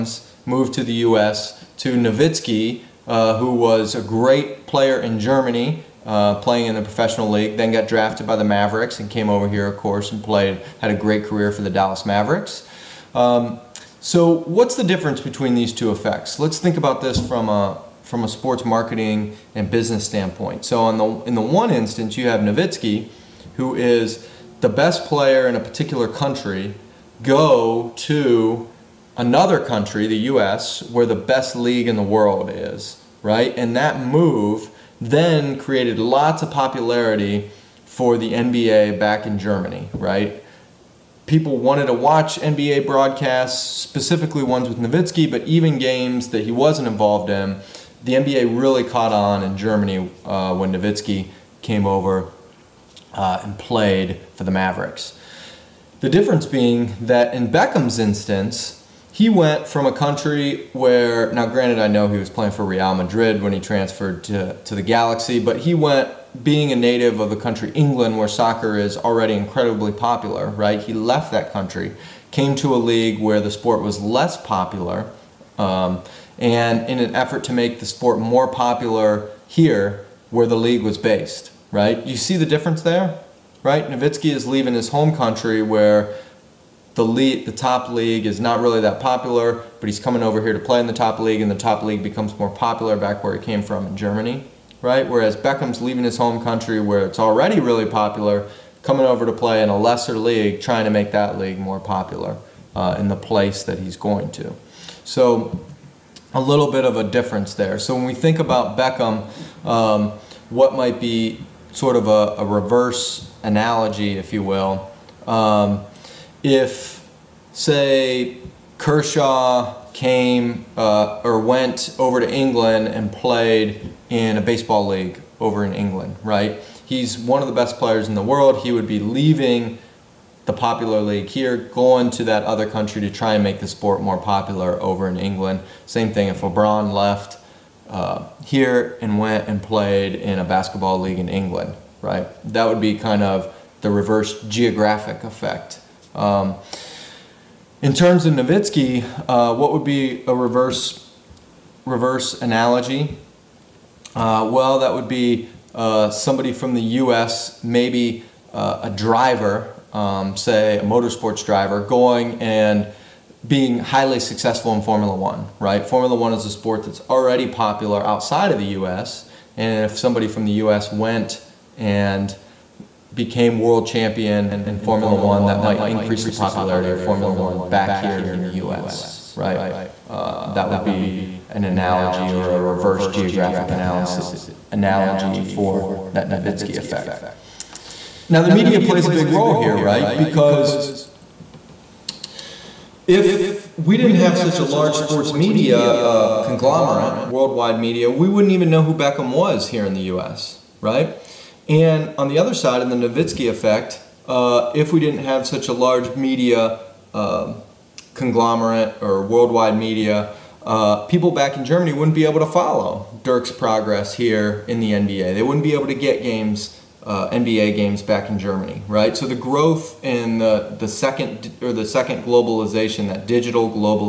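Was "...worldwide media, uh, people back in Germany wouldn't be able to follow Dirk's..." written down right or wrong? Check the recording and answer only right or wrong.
right.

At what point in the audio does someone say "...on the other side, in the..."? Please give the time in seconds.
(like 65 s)
202 s.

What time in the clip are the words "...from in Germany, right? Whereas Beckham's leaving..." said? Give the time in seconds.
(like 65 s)
93 s.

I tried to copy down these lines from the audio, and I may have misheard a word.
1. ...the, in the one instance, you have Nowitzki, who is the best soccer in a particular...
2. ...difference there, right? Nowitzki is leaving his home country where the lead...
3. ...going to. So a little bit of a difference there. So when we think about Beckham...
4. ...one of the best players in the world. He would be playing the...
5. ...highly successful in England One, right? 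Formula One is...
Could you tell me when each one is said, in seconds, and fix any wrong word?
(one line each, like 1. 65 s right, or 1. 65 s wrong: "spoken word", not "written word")
1. 20 s wrong: "player", not "soccer"
2. 82 s right
3. 103 s right
4. 127 s wrong: "leaving", not "playing"
5. 163 s wrong: "Formula", not "England".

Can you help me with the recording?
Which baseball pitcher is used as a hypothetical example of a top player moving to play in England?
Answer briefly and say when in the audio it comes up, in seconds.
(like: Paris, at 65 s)
Kershaw, at 118 s.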